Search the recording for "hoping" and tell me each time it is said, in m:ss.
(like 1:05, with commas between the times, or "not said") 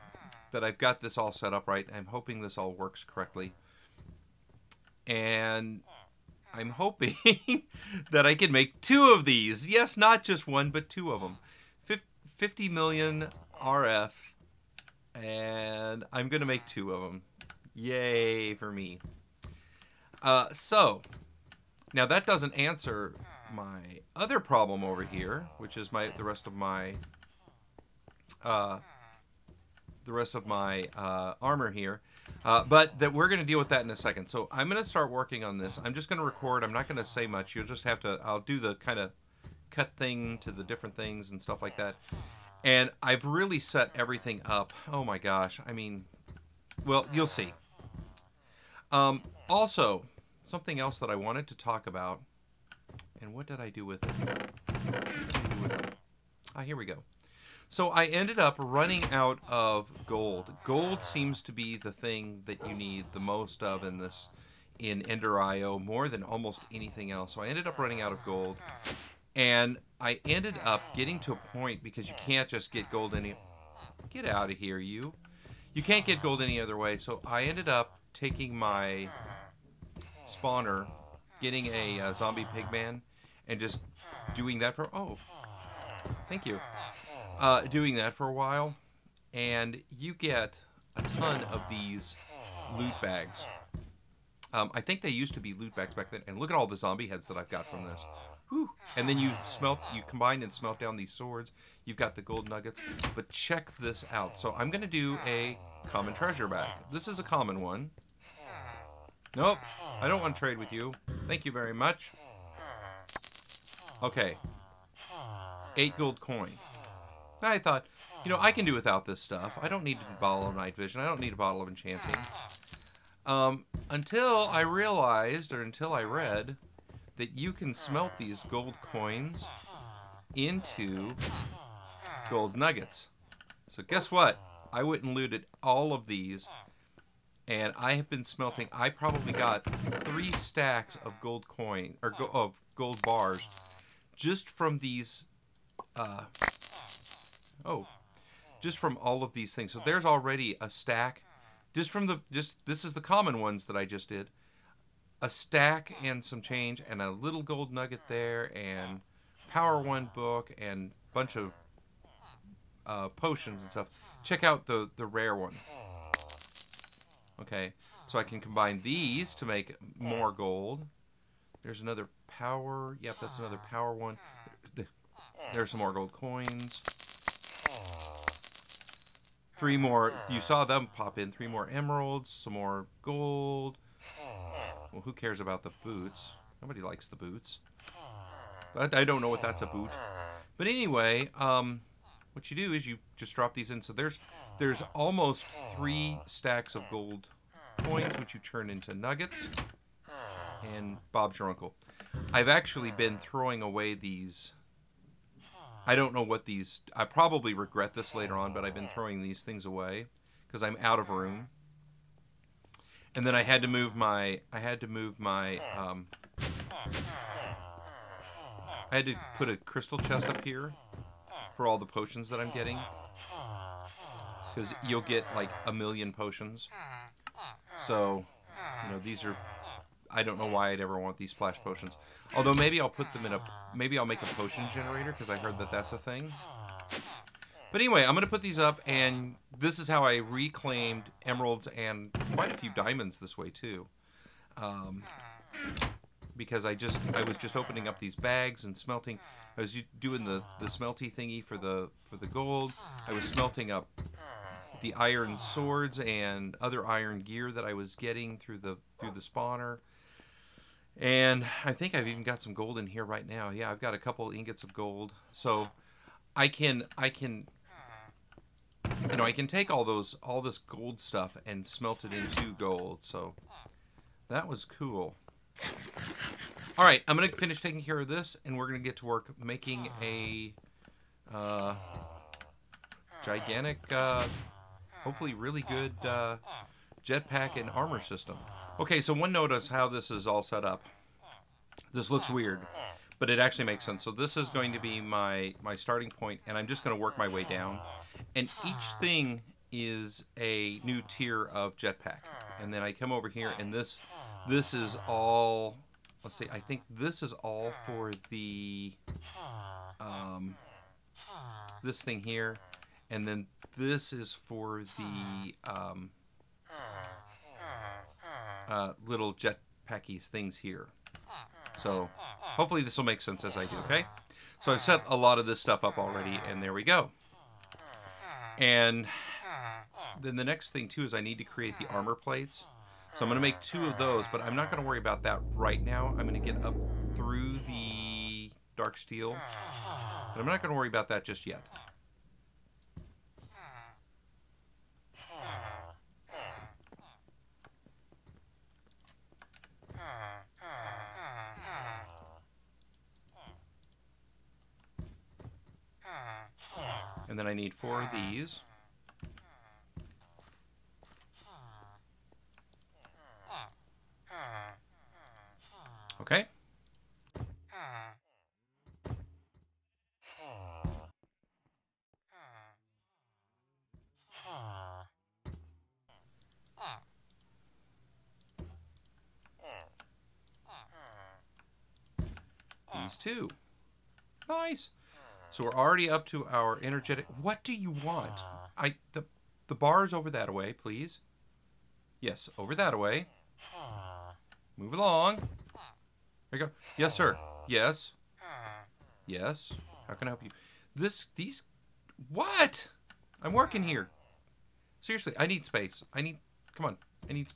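0:02, 0:06.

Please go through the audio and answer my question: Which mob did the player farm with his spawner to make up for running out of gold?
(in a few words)
zombie pigman.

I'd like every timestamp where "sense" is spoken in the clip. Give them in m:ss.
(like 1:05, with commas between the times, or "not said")
4:53, 5:23.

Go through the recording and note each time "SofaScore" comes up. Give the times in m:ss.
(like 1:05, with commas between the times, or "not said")
not said.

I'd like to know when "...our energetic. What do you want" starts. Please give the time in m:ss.
6:26.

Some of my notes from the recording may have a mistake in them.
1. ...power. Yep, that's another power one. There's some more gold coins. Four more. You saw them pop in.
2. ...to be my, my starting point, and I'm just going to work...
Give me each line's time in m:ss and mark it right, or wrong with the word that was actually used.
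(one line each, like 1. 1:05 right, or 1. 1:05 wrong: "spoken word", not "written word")
1. 2:52 wrong: "Three", not "Four"
2. 4:54 right.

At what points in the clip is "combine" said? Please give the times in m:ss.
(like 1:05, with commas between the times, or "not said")
1:40, 2:48.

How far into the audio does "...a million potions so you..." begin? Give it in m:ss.
3:45.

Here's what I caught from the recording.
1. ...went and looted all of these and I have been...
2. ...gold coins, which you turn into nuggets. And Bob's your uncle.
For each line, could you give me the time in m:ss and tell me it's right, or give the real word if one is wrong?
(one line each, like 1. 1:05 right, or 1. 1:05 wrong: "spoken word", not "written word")
1. 2:14 right
2. 3:16 right.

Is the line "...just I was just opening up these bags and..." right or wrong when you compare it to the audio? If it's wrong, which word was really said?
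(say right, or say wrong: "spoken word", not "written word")
right.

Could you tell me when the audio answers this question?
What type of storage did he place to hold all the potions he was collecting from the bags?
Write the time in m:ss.
3:39.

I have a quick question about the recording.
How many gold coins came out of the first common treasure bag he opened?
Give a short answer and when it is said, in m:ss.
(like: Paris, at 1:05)
8, at 1:55.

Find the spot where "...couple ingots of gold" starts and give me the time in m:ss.
4:23.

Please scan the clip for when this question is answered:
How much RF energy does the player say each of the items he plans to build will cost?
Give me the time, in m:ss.
0:12.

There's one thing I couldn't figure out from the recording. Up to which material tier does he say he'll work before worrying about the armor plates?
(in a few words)
dark steel.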